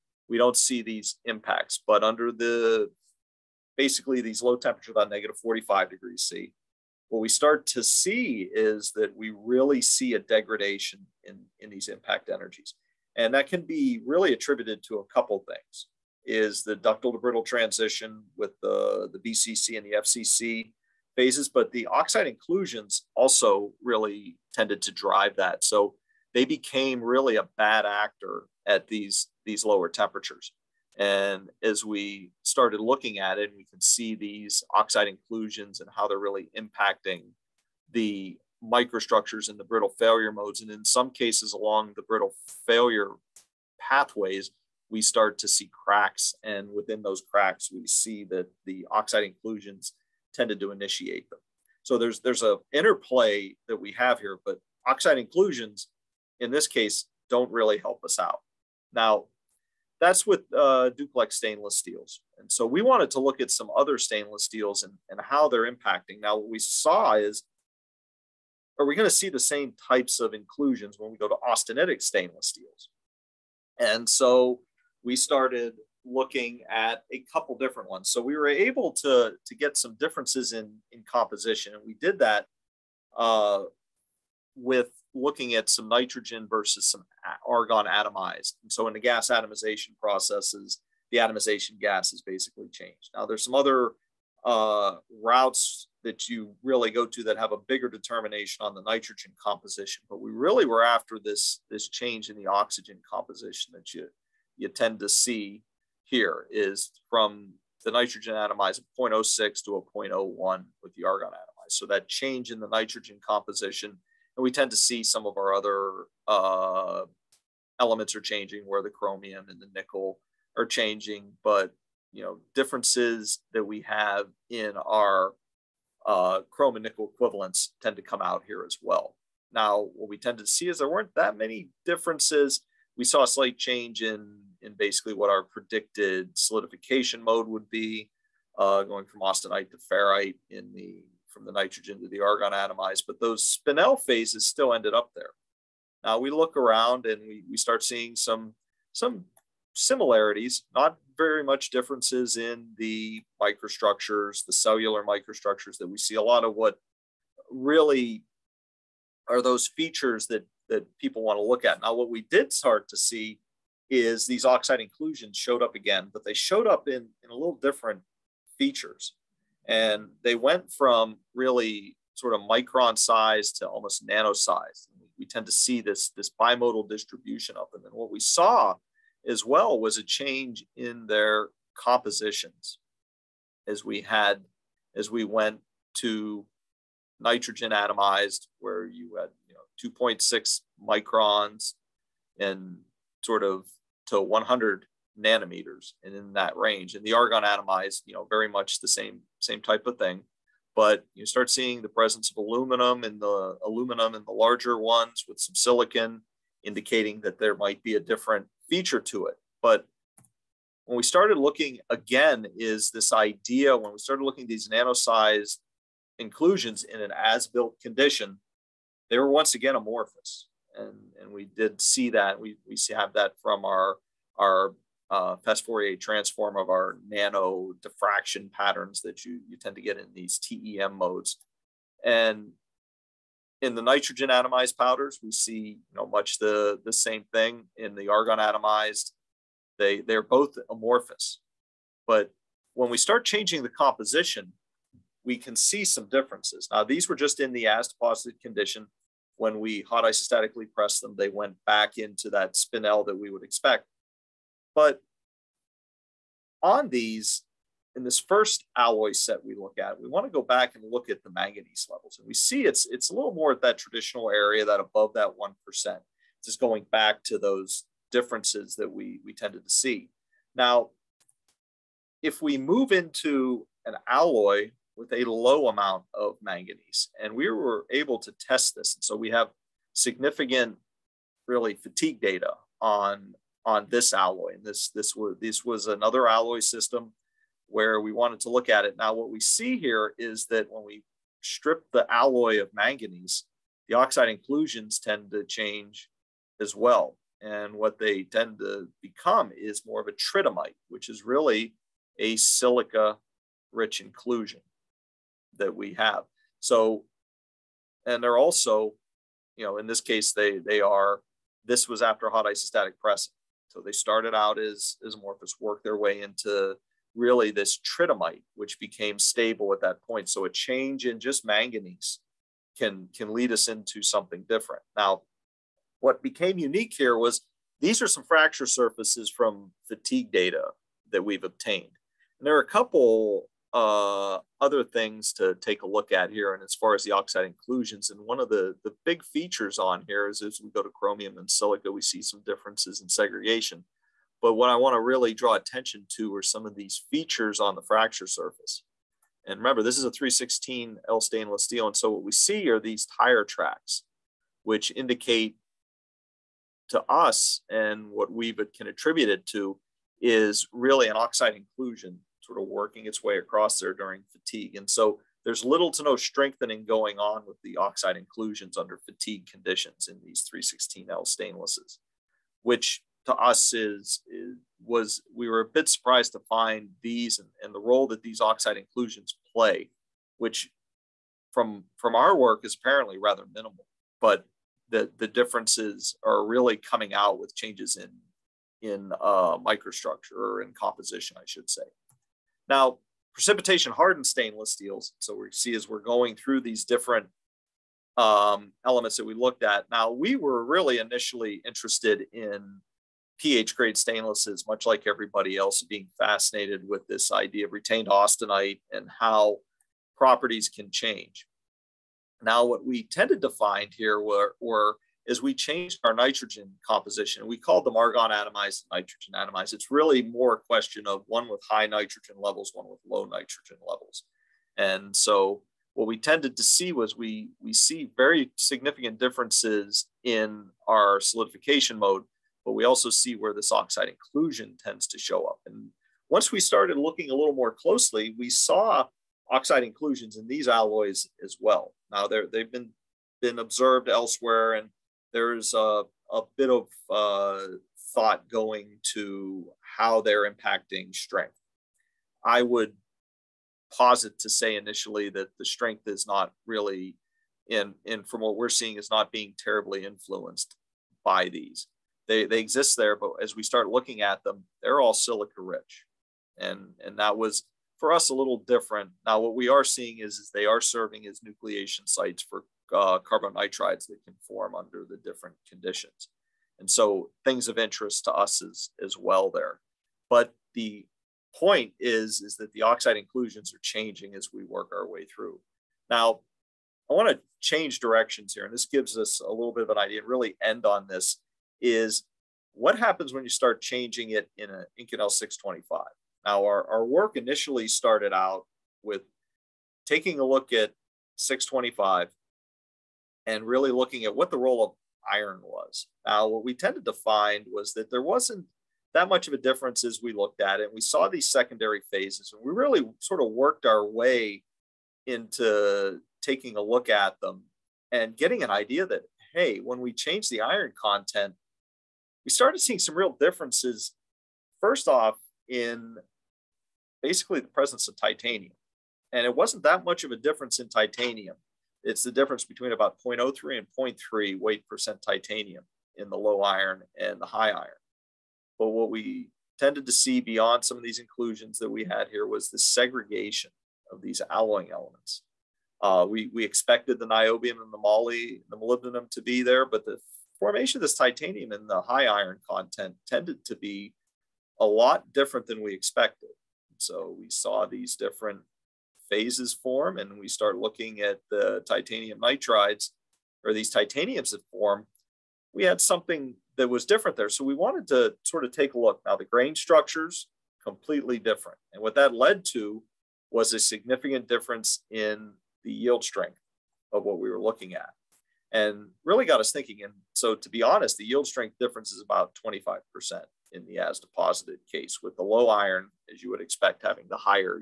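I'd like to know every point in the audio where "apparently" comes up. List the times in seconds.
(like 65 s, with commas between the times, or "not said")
382 s.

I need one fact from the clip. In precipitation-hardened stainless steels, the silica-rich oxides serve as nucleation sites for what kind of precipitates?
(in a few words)
carbon nitrides.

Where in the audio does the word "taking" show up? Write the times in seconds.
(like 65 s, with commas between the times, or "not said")
500 s, 516 s.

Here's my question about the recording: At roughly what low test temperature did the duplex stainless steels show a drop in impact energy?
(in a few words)
-45 degrees C.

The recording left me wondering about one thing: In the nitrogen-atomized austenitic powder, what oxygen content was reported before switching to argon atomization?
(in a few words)
0.06.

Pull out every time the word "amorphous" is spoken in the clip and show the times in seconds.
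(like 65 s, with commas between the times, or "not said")
219 s, 240 s, 315 s.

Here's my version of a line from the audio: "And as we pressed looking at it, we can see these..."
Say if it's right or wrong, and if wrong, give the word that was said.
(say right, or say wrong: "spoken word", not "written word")
wrong: "started", not "pressed".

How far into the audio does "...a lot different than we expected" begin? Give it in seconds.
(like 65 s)
554 s.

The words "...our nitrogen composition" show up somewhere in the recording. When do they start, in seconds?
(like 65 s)
416 s.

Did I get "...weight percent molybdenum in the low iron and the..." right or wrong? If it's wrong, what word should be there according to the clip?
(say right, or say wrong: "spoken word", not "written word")
wrong: "titanium", not "molybdenum".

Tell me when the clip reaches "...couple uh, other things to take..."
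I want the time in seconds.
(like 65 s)
332 s.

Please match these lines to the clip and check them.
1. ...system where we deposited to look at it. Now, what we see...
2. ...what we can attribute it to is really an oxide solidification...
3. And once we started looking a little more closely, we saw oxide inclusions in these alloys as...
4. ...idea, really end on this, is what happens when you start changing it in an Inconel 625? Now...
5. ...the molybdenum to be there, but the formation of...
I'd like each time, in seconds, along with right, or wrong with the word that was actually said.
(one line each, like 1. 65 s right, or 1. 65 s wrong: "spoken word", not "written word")
1. 286 s wrong: "wanted", not "deposited"
2. 358 s wrong: "inclusion", not "solidification"
3. 435 s right
4. 489 s right
5. 548 s right.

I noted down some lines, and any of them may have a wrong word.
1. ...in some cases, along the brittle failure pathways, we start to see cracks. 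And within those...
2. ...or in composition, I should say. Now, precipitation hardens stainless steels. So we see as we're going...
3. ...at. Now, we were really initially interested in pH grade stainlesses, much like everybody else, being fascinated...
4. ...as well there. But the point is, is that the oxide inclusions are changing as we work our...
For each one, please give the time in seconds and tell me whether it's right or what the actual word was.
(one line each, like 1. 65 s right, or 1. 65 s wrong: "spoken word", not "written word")
1. 40 s right
2. 390 s right
3. 399 s right
4. 479 s right.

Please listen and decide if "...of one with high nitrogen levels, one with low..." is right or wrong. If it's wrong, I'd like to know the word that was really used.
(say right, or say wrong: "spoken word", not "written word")
right.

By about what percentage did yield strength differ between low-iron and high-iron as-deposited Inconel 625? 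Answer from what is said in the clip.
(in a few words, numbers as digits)
25%.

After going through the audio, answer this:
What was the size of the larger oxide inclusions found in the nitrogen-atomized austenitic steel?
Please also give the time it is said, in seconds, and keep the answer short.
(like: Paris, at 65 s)
2.6 microns, at 190 s.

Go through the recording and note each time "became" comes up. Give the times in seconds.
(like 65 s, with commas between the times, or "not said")
26 s, 318 s, 326 s.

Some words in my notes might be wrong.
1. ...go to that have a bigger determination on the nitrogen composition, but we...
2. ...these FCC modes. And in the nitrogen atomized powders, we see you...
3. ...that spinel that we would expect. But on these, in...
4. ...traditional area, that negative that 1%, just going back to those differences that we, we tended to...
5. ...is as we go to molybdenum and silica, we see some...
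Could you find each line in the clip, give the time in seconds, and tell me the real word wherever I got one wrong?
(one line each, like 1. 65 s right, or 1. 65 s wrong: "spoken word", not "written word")
1. 96 s right
2. 230 s wrong: "TEM", not "FCC"
3. 252 s right
4. 263 s wrong: "above", not "negative"
5. 340 s wrong: "chromium", not "molybdenum".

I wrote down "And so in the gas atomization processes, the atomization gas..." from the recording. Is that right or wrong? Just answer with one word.
right.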